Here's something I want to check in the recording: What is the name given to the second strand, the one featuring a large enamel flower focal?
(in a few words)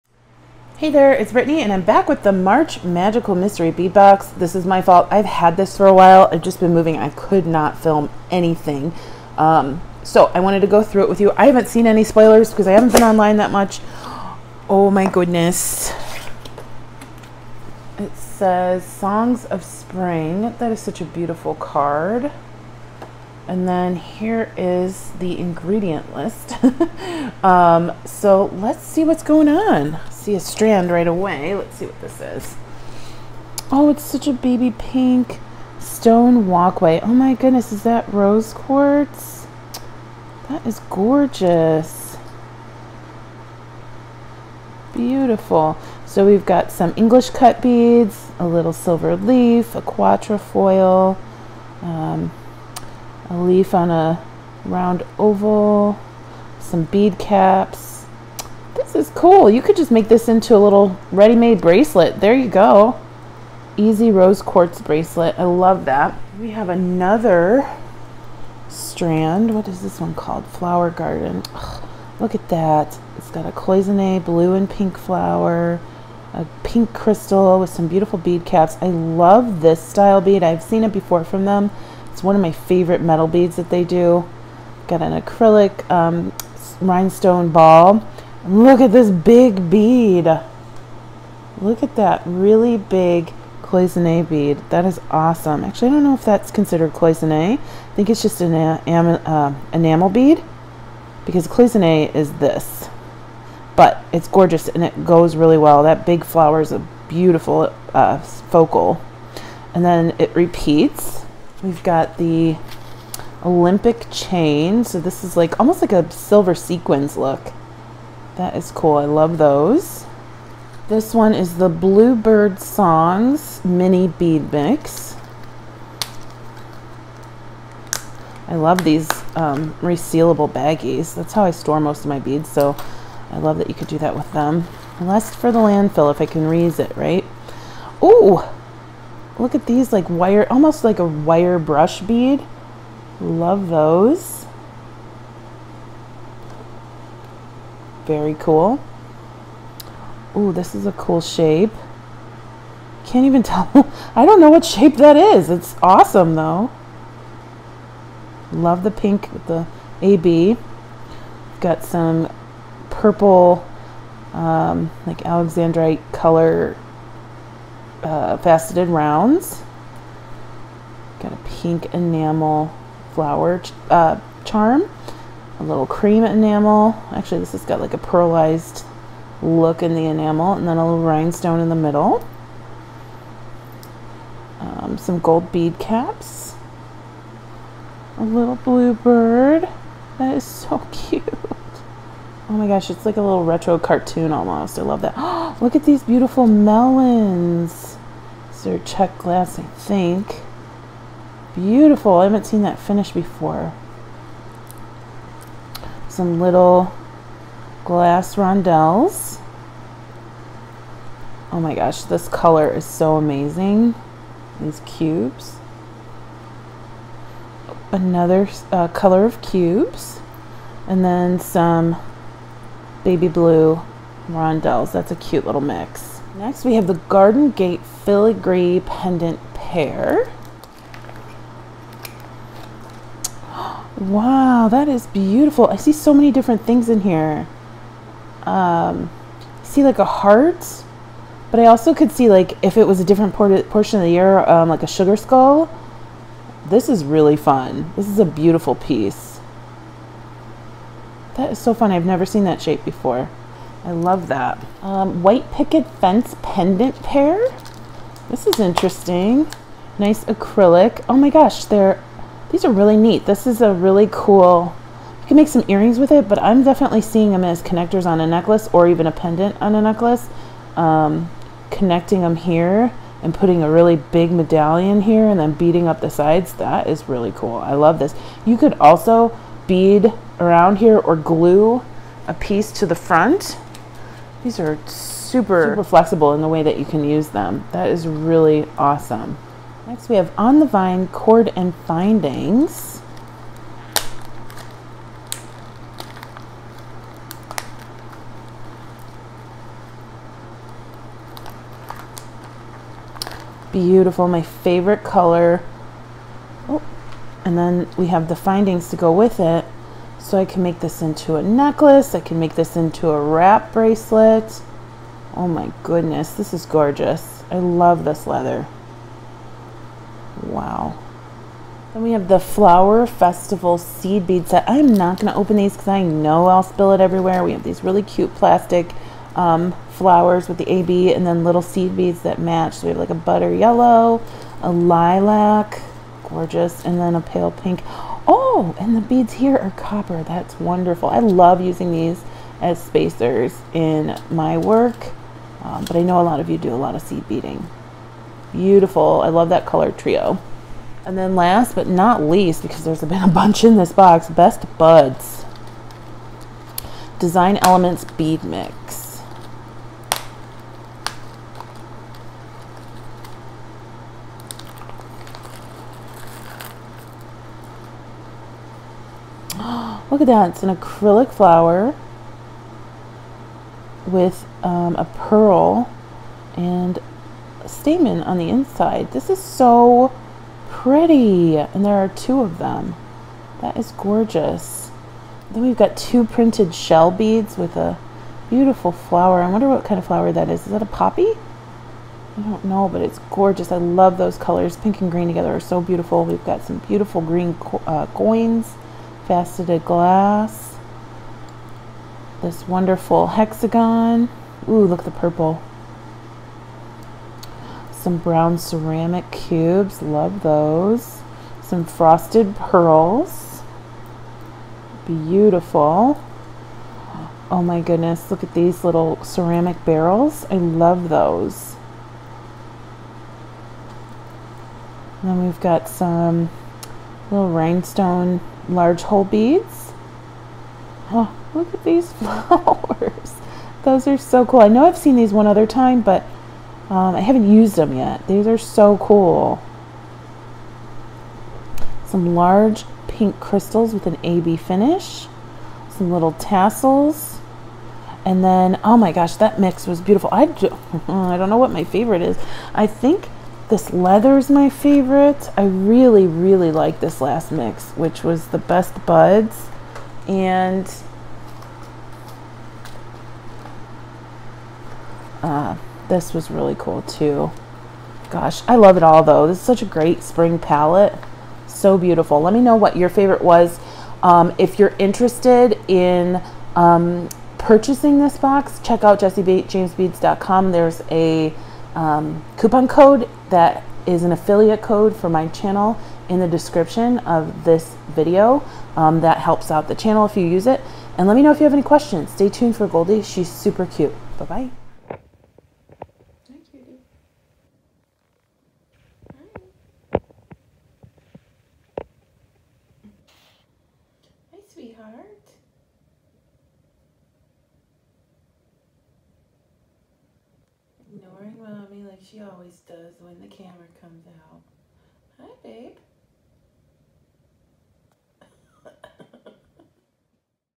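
Flower garden.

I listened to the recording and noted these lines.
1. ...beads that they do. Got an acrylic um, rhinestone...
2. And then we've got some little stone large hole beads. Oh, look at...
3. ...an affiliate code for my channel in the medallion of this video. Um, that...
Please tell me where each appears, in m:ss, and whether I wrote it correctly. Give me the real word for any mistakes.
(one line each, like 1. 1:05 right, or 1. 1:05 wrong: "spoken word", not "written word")
1. 1:23 right
2. 7:05 wrong: "rhinestone", not "stone"
3. 8:04 wrong: "description", not "medallion".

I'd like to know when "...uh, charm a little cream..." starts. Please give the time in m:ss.
2:53.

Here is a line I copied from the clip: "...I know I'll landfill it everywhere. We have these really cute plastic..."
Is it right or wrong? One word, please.
wrong.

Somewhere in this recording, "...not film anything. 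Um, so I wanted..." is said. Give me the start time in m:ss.
0:07.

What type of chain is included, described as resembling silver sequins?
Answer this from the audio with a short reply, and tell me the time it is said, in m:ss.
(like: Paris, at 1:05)
Olympic chain, at 1:53.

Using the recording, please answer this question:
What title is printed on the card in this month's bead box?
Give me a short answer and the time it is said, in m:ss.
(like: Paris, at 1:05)
Songs of Spring, at 0:18.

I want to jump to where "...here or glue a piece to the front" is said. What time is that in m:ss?
4:40.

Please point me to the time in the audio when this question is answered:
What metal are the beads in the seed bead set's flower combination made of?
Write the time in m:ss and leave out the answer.
5:39.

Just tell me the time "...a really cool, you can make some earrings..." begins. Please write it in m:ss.
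4:23.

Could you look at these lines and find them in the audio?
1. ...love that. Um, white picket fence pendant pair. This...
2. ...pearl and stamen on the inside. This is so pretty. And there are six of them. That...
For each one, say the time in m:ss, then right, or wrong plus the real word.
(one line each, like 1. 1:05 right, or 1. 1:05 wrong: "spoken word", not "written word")
1. 4:13 right
2. 6:15 wrong: "two", not "six".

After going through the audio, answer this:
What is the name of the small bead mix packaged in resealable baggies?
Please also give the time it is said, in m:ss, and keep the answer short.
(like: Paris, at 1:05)
Bluebird Songs, at 2:01.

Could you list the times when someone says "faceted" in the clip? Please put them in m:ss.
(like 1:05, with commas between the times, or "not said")
2:48, 6:39.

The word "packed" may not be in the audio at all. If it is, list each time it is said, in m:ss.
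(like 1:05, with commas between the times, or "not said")
not said.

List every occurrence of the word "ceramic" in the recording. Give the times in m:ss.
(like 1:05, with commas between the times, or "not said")
6:48, 6:59.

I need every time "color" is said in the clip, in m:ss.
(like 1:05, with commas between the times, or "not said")
2:46, 3:32, 3:38, 5:05, 5:49, 6:34.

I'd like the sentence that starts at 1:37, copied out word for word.
I think it's just an um, uh, enamel bead because cloisonne is this.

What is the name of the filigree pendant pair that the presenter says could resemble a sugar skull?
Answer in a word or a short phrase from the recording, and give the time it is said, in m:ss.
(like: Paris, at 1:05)
Garden Gate, at 3:46.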